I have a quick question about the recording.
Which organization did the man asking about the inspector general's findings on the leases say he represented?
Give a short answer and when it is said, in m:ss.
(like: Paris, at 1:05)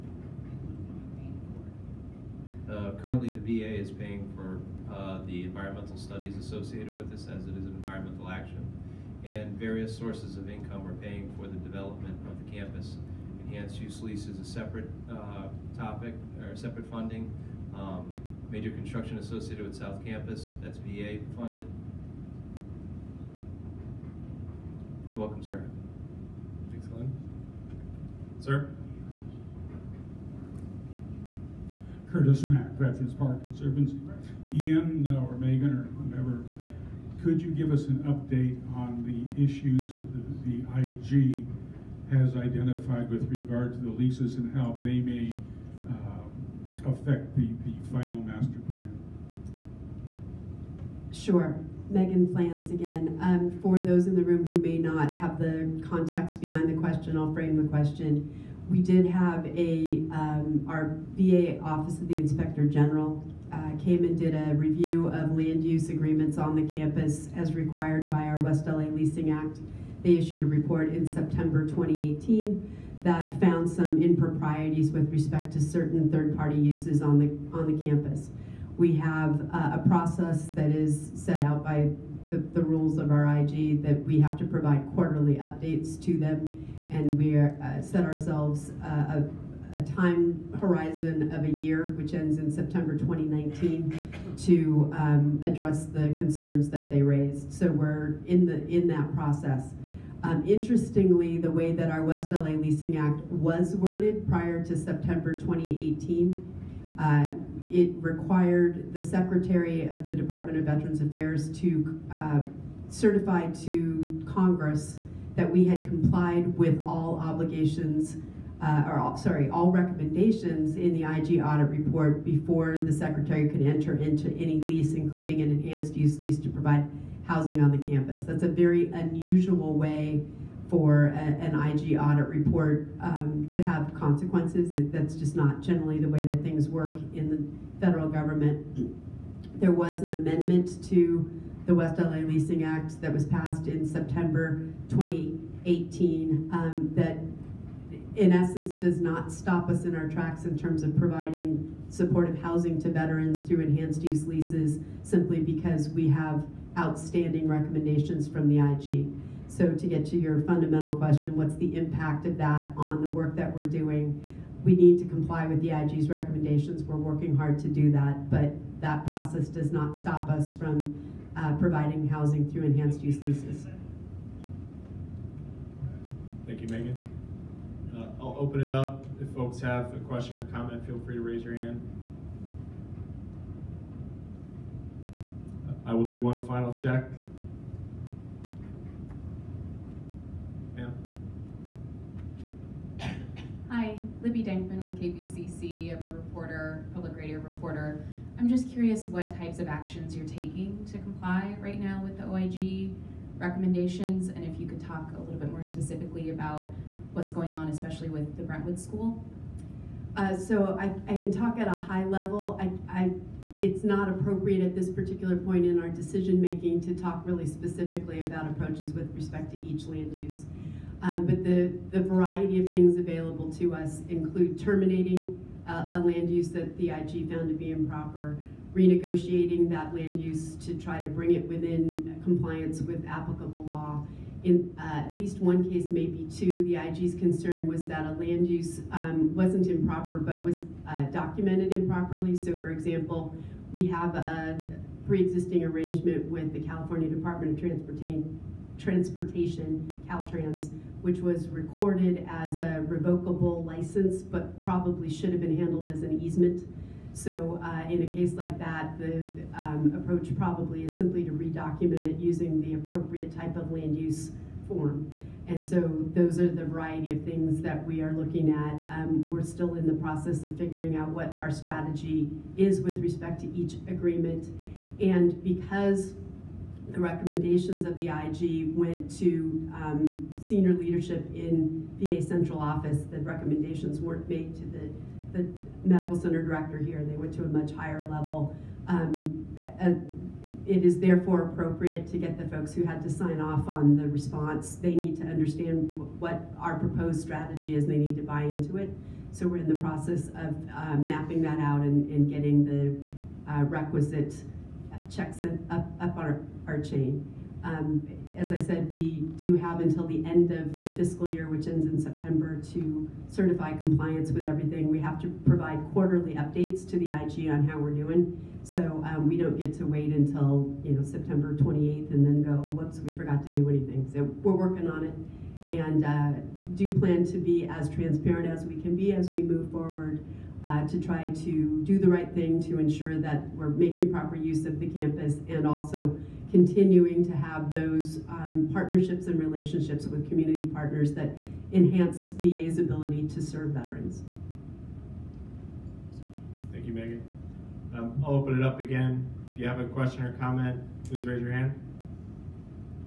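Veterans Park Conservancy, at 0:32.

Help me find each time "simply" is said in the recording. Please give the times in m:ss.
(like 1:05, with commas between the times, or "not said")
2:35, 4:20.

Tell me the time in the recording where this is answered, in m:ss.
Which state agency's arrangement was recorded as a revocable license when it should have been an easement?
4:10.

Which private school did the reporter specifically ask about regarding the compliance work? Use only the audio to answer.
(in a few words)
Brentwood School.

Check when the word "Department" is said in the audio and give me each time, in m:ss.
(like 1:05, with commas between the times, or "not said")
1:50, 4:07.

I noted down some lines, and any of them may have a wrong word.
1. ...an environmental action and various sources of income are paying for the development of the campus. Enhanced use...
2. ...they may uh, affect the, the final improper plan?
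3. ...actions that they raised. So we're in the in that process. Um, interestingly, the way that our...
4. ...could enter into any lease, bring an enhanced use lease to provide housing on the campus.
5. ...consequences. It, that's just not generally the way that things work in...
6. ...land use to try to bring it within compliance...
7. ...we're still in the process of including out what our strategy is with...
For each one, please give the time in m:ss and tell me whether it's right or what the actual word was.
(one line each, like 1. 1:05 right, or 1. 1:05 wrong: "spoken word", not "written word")
1. 0:07 right
2. 0:44 wrong: "master", not "improper"
3. 1:36 wrong: "concerns", not "actions"
4. 2:03 wrong: "including", not "bring"
5. 2:13 right
6. 3:49 right
7. 4:29 wrong: "figuring", not "including".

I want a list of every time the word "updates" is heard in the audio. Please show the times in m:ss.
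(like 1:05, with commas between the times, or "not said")
0:38, 1:25, 5:16.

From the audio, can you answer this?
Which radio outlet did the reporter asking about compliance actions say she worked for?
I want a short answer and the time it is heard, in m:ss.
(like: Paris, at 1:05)
KPCC, at 3:14.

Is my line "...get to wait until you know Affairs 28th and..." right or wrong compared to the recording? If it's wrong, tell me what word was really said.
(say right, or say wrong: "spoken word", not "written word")
wrong: "September", not "Affairs".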